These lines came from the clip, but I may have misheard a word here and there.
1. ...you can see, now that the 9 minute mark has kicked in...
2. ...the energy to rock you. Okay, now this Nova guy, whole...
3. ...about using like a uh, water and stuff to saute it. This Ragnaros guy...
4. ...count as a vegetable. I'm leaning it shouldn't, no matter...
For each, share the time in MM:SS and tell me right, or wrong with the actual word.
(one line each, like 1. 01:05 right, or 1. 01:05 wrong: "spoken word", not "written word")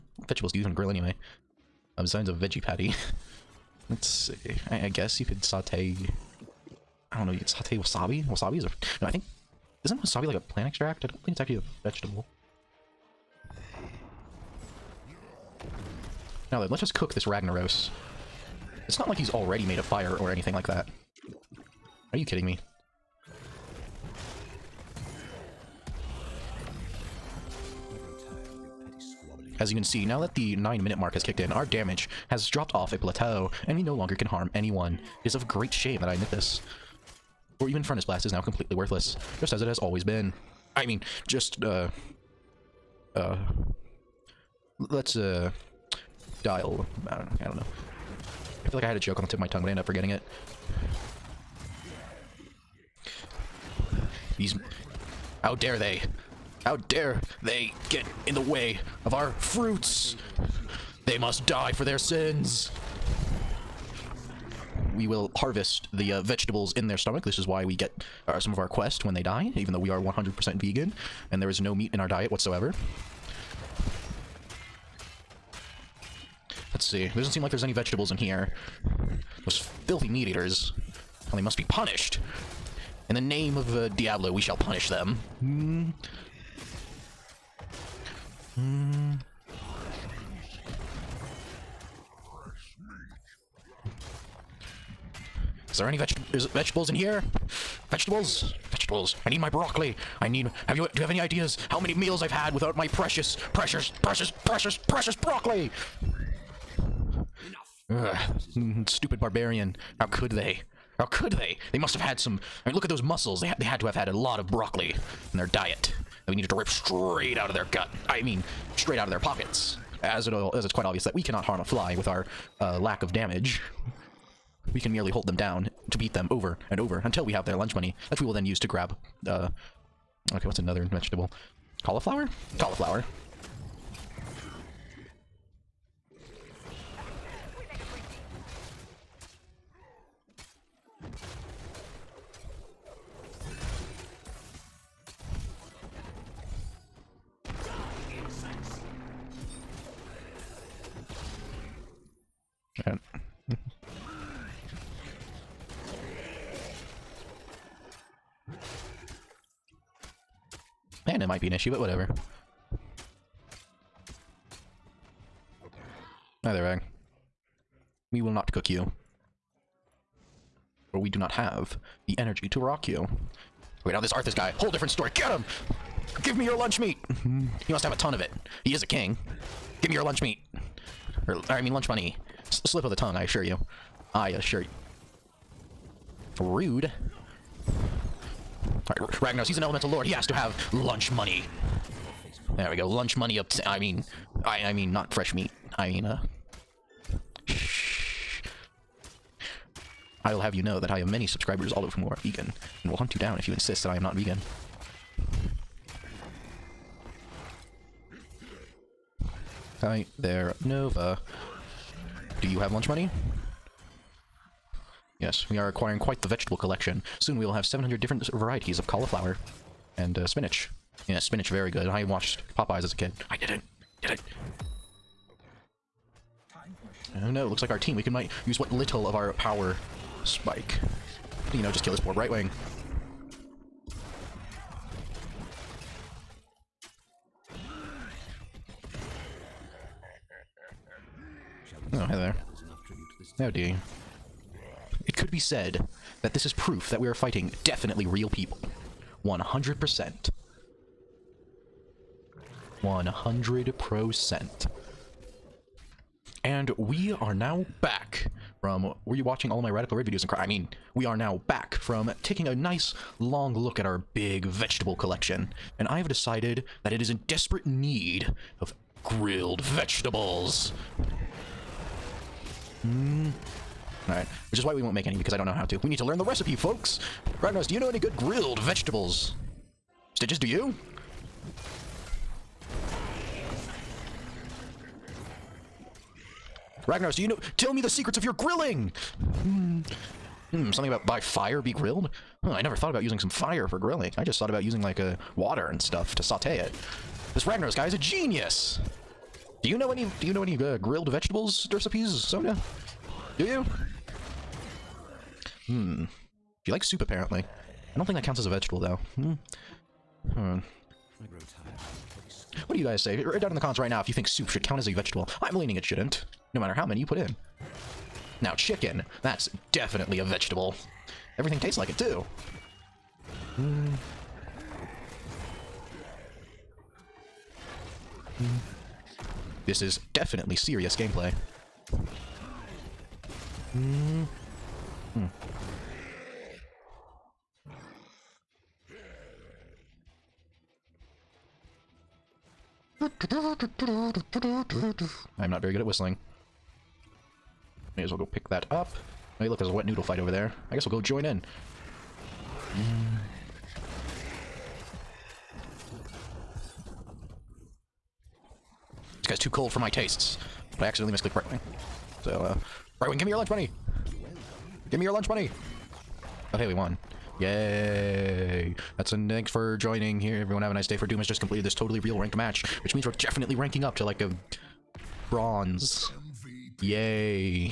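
1. 00:29 right
2. 02:52 wrong: "Arthas", not "Nova"
3. 04:54 right
4. 05:14 right.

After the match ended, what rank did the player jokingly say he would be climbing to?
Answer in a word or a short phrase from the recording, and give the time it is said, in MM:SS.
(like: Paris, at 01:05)
bronze, at 06:15.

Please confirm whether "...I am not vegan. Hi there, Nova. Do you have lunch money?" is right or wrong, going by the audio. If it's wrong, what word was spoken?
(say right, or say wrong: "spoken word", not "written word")
right.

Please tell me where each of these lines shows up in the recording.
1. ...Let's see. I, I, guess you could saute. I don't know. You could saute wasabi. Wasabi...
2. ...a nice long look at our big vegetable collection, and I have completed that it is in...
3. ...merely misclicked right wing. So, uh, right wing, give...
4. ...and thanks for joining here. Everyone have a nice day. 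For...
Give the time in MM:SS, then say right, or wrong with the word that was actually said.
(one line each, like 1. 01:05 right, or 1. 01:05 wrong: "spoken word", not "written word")
1. 00:03 right
2. 04:22 wrong: "decided", not "completed"
3. 06:00 wrong: "accidentally", not "merely"
4. 06:09 right.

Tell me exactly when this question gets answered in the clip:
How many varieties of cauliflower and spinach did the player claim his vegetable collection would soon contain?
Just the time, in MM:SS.
03:37.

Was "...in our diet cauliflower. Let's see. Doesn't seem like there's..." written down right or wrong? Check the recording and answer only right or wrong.
wrong.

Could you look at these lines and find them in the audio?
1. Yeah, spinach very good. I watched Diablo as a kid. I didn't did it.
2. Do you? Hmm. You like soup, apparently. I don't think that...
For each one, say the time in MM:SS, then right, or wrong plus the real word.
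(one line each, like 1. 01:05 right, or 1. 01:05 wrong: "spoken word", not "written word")
1. 03:41 wrong: "Popeyes", not "Diablo"
2. 05:03 right.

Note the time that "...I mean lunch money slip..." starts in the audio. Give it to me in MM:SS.
03:01.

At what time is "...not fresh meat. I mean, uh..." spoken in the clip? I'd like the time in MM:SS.
03:14.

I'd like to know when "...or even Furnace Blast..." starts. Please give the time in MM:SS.
00:37.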